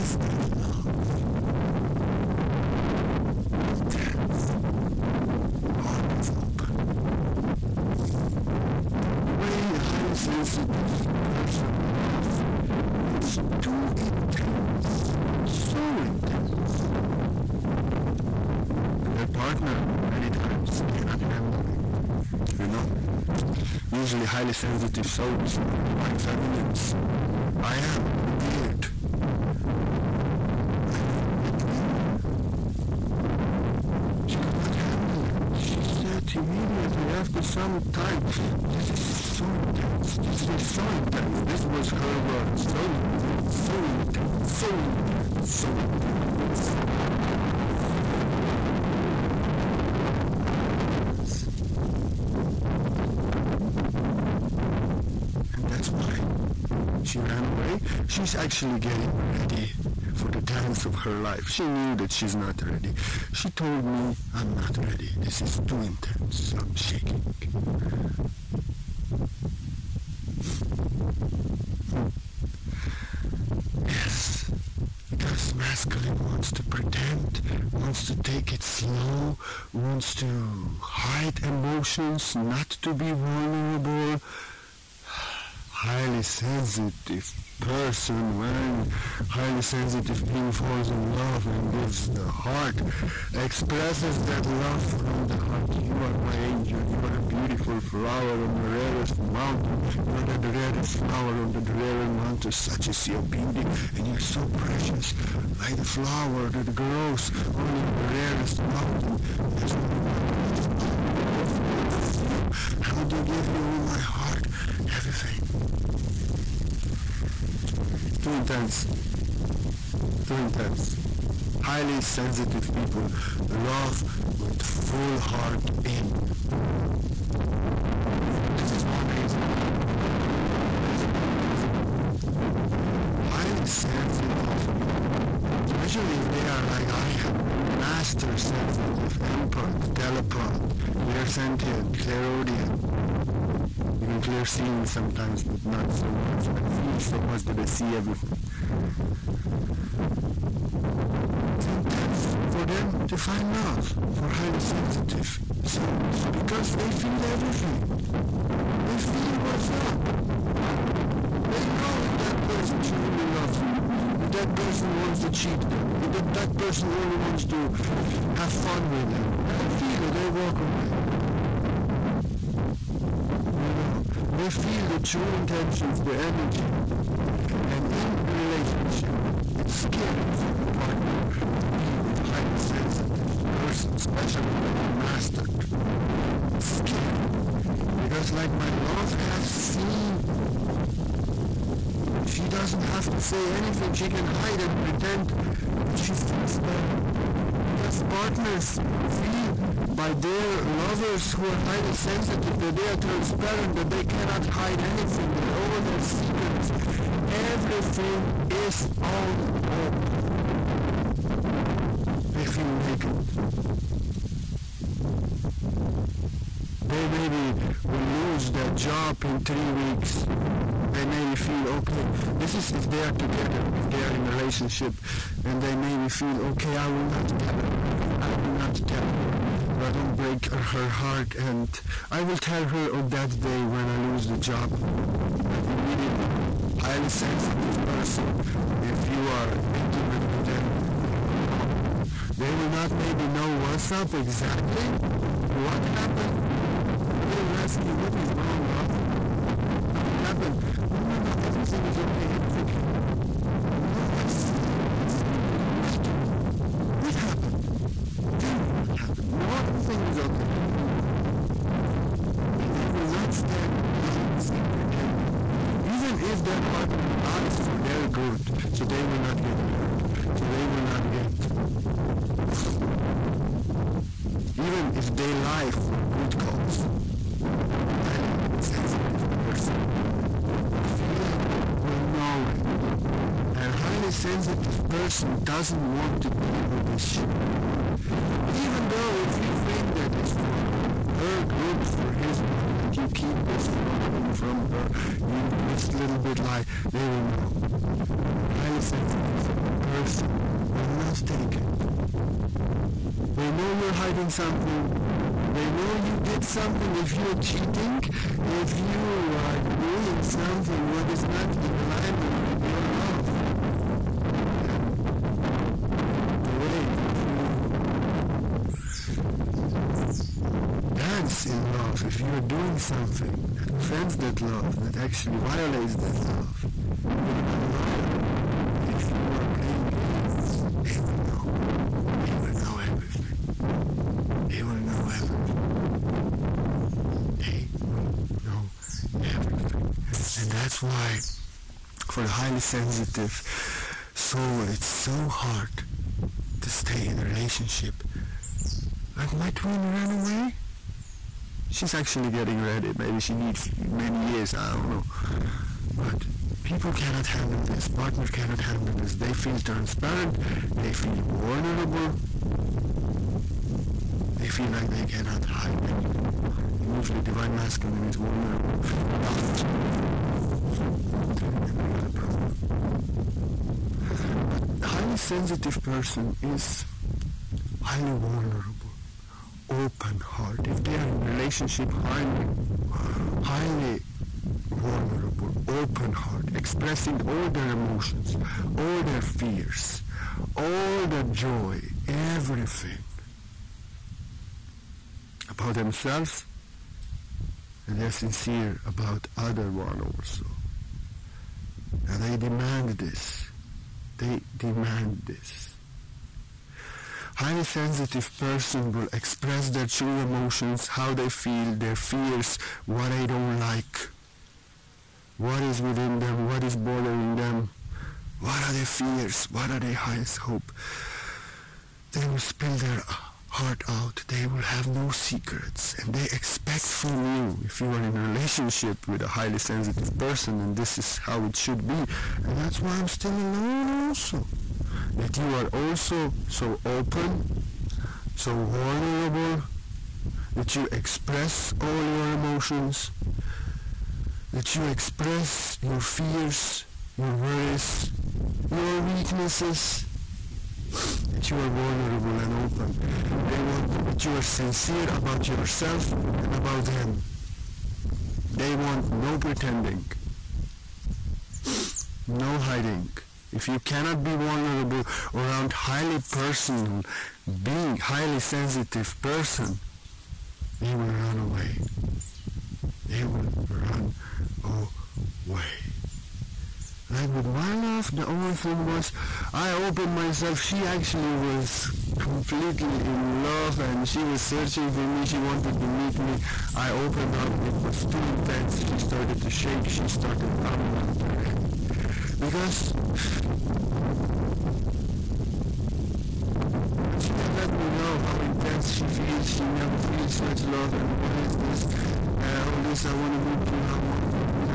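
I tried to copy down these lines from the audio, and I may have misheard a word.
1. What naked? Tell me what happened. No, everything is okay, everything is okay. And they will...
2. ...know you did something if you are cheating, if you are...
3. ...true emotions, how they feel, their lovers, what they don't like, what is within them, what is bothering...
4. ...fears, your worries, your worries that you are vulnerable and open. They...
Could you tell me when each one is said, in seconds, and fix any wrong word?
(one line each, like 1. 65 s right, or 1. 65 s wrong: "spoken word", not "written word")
1. 257 s wrong: "happened", not "naked"
2. 305 s right
3. 409 s wrong: "fears", not "lovers"
4. 446 s wrong: "weaknesses", not "worries".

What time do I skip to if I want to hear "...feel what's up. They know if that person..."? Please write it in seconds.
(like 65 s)
158 s.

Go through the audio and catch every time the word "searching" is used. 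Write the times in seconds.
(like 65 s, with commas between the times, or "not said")
484 s.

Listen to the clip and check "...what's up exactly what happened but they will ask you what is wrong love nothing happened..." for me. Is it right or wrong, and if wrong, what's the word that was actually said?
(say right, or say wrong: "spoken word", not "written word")
right.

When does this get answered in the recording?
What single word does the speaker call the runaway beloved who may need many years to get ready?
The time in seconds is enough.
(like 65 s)
349 s.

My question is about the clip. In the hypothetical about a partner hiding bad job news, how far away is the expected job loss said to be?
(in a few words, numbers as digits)
3 weeks.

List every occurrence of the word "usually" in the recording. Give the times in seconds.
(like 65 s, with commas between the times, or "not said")
23 s, 366 s.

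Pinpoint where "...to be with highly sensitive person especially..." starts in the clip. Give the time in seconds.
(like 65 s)
181 s.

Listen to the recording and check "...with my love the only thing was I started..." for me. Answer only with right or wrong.
wrong.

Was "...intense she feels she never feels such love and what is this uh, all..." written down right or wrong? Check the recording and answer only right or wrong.
right.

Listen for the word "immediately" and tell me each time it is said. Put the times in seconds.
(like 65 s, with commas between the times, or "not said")
36 s, 235 s.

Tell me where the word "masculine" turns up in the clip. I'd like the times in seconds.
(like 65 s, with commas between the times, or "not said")
75 s, 367 s.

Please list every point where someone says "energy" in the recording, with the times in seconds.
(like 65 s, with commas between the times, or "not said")
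176 s.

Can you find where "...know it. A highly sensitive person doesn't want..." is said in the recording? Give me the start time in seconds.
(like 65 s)
282 s.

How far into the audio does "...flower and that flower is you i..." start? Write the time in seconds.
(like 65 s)
110 s.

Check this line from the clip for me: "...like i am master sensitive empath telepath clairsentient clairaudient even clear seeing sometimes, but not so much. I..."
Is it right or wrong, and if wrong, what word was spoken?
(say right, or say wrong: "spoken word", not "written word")
right.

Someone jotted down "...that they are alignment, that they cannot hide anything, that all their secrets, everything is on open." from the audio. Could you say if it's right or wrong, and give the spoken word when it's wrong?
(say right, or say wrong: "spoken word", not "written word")
wrong: "transparent", not "alignment".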